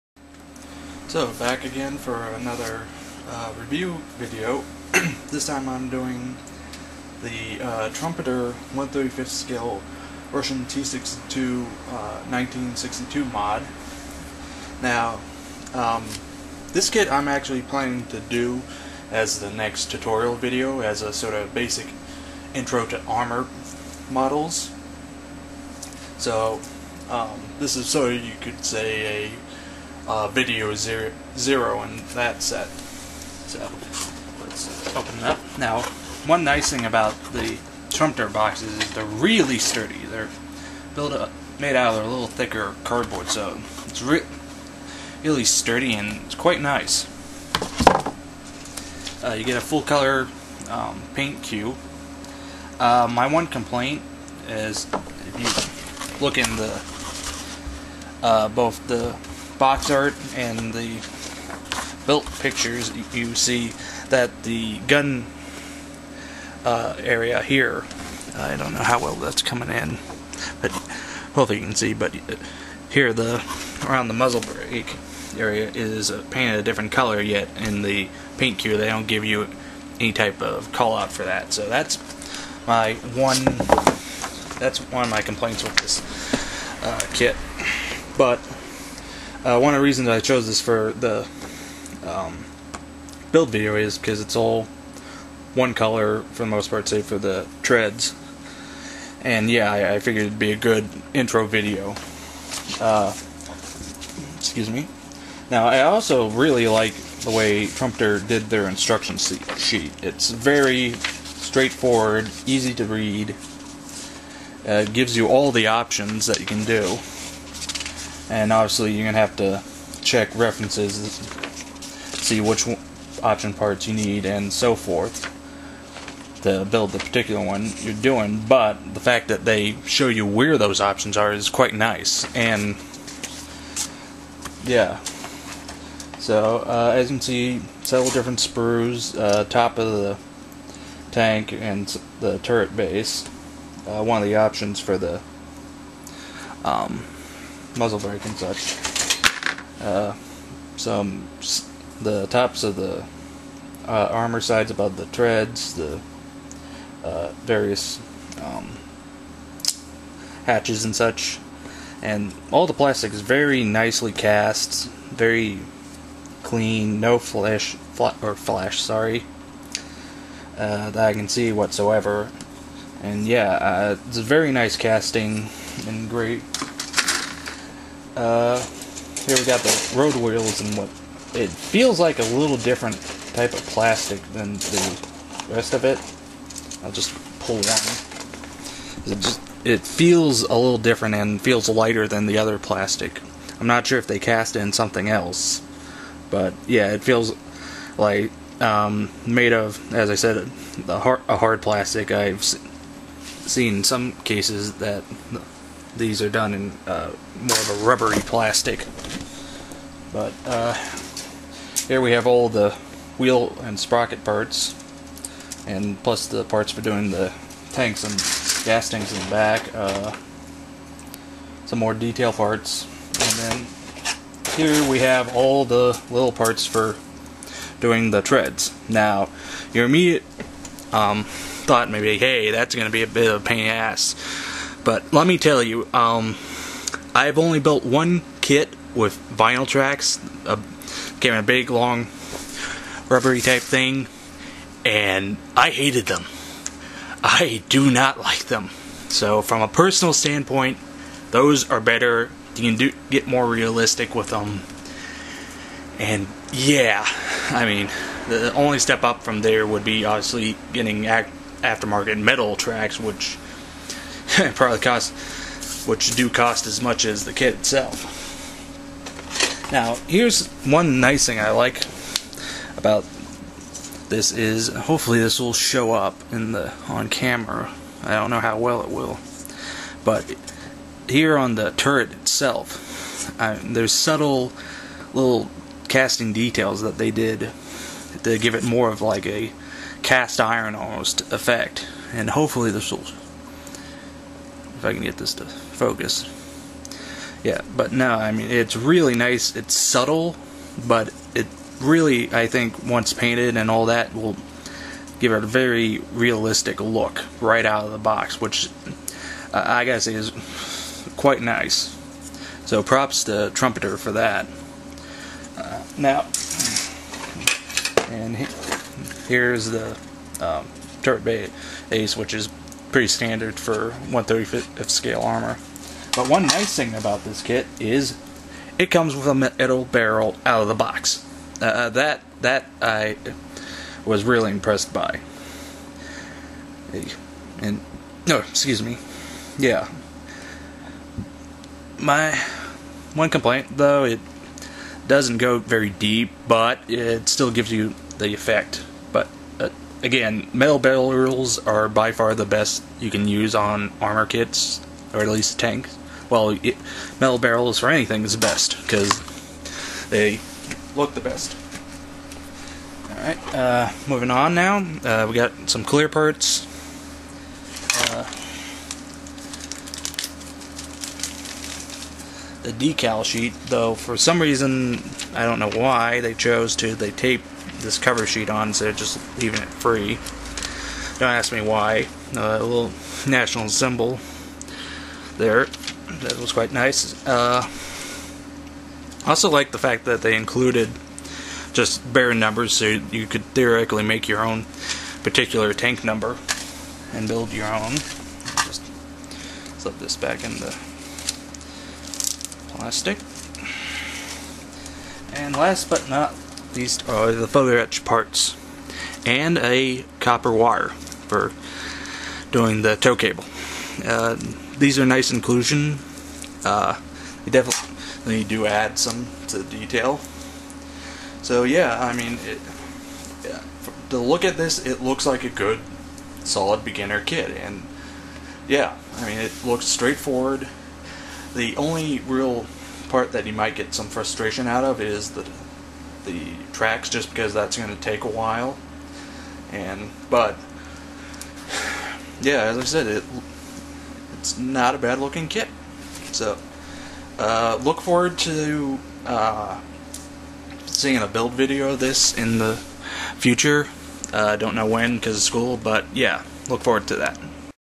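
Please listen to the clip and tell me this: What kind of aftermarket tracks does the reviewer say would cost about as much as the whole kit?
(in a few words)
metal tracks.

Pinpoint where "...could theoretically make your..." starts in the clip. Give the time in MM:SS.
06:33.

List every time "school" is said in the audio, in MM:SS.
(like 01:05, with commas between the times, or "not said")
07:35.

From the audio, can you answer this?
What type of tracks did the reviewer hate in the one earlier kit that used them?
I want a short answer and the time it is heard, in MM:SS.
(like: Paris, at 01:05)
vinyl tracks, at 03:59.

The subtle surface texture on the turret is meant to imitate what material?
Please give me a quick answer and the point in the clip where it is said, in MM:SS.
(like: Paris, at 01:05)
cast iron, at 04:50.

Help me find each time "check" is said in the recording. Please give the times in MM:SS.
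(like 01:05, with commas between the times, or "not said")
02:00.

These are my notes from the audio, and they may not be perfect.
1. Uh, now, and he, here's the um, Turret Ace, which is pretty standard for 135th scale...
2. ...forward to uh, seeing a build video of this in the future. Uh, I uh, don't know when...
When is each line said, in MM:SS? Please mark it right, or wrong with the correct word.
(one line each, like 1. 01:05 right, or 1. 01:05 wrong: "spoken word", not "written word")
1. 05:15 right
2. 07:28 right.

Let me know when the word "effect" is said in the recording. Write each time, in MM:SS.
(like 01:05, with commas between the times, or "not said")
04:51, 05:48.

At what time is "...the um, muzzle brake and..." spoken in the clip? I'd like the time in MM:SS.
02:24.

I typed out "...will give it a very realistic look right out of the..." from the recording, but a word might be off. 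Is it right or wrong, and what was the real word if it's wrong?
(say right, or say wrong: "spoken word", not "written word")
right.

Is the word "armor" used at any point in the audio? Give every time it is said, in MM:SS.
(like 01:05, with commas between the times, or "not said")
00:23, 02:34, 05:25, 05:54.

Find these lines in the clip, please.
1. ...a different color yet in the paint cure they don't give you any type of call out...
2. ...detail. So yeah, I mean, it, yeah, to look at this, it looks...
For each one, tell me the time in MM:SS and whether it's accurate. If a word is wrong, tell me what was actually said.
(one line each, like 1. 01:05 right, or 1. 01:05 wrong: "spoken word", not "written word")
1. 01:16 right
2. 06:59 right.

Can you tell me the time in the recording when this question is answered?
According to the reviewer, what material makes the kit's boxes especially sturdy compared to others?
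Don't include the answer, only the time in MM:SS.
00:42.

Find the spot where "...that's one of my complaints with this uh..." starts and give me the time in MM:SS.
01:24.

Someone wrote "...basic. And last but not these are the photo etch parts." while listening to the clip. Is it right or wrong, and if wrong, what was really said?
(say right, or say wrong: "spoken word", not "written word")
wrong: "plastic", not "basic".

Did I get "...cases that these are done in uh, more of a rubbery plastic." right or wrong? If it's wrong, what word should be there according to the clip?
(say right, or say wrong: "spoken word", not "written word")
right.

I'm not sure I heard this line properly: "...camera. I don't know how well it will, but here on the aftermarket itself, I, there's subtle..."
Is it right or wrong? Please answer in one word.
wrong.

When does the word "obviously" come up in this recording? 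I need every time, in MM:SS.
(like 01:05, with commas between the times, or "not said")
01:58, 04:20.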